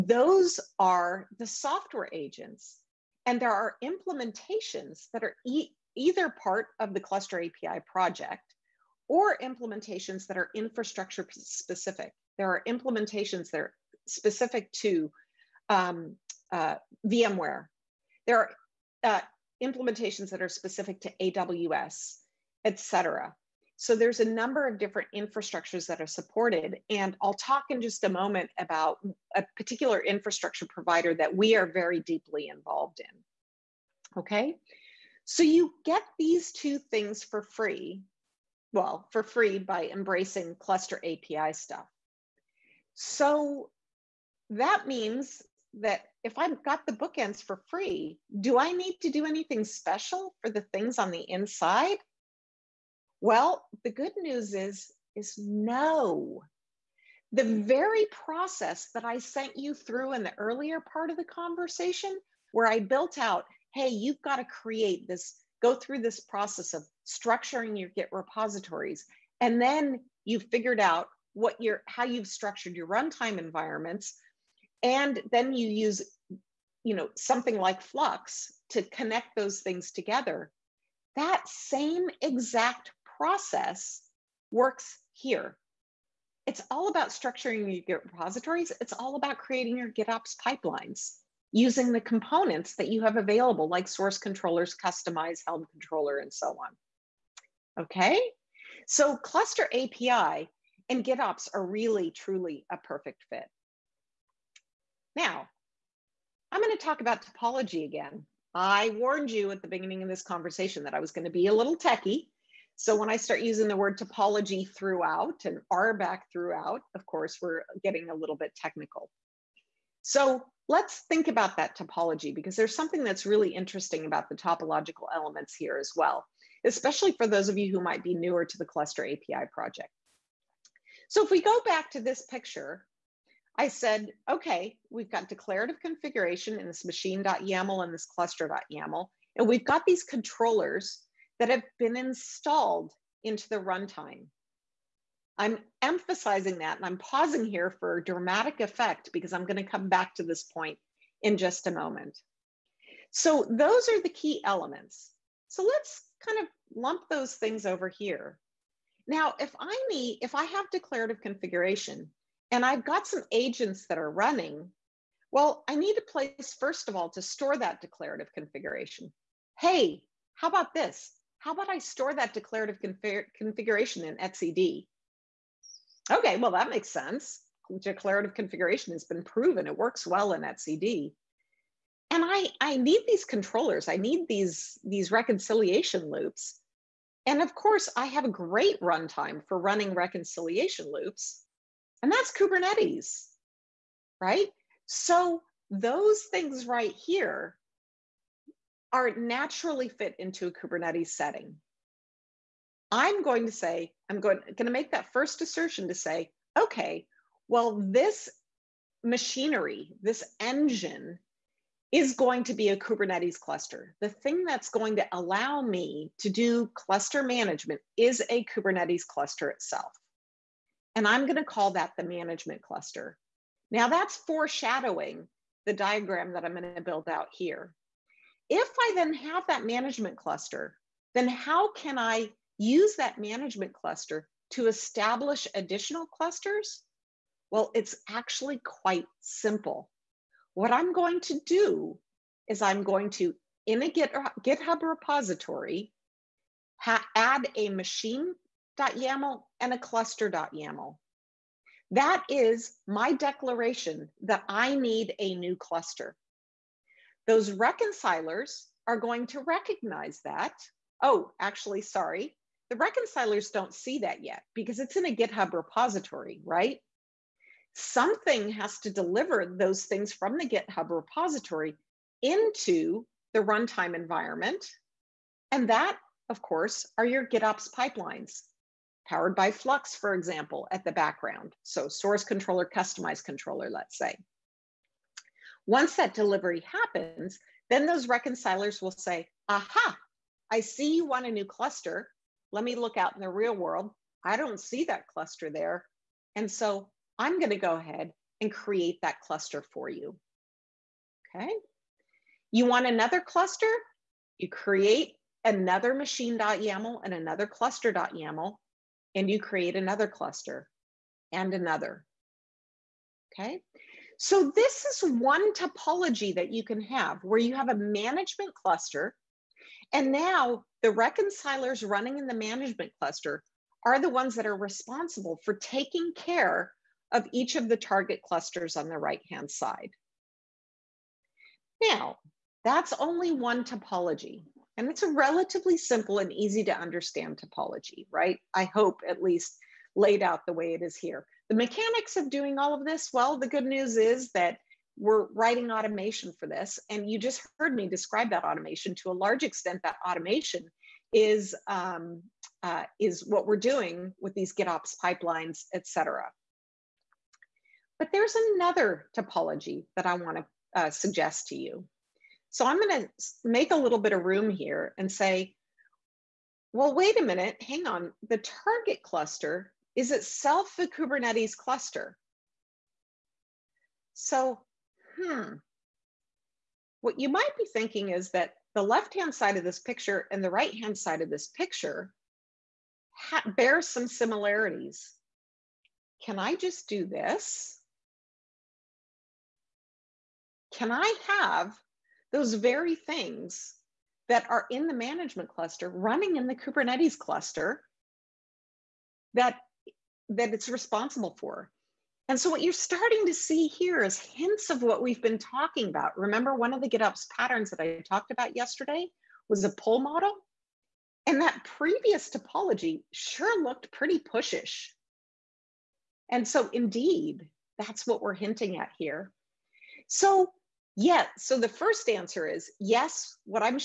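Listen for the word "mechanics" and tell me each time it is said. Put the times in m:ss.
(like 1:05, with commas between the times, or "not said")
5:41.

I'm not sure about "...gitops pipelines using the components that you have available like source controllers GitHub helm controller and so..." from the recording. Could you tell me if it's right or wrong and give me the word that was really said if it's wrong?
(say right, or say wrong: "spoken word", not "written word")
wrong: "Kustomize", not "GitHub".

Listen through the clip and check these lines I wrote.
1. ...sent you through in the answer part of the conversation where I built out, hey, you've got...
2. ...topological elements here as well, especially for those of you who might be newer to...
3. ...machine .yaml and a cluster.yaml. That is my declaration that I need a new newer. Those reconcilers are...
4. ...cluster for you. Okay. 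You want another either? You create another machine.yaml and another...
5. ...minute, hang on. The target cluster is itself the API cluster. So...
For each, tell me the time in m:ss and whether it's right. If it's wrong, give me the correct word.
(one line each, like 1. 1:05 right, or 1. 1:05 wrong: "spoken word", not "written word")
1. 0:59 wrong: "earlier", not "answer"
2. 2:04 right
3. 4:07 wrong: "cluster", not "newer"
4. 4:59 wrong: "cluster", not "either"
5. 6:07 wrong: "Kubernetes", not "API".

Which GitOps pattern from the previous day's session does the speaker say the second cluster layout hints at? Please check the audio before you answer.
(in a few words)
Pull model.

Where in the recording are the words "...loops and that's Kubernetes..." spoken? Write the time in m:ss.
3:10.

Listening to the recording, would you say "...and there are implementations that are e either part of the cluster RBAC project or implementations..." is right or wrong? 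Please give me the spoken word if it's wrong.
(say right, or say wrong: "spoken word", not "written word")
wrong: "API", not "RBAC".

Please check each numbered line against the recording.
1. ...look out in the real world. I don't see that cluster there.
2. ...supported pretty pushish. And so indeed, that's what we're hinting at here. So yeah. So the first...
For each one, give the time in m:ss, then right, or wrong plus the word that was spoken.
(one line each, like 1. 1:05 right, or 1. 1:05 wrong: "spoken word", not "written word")
1. 4:52 right
2. 6:53 wrong: "looked", not "supported".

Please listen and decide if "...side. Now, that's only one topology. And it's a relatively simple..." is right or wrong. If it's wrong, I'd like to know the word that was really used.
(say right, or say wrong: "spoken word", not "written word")
right.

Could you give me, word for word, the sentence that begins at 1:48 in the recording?
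I warned you at the beginning of this conversation that I was going to be a little techie.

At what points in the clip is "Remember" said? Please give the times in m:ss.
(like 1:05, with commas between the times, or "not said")
6:46.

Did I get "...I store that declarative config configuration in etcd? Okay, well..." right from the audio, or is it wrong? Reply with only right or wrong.
right.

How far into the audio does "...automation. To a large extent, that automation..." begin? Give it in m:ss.
5:48.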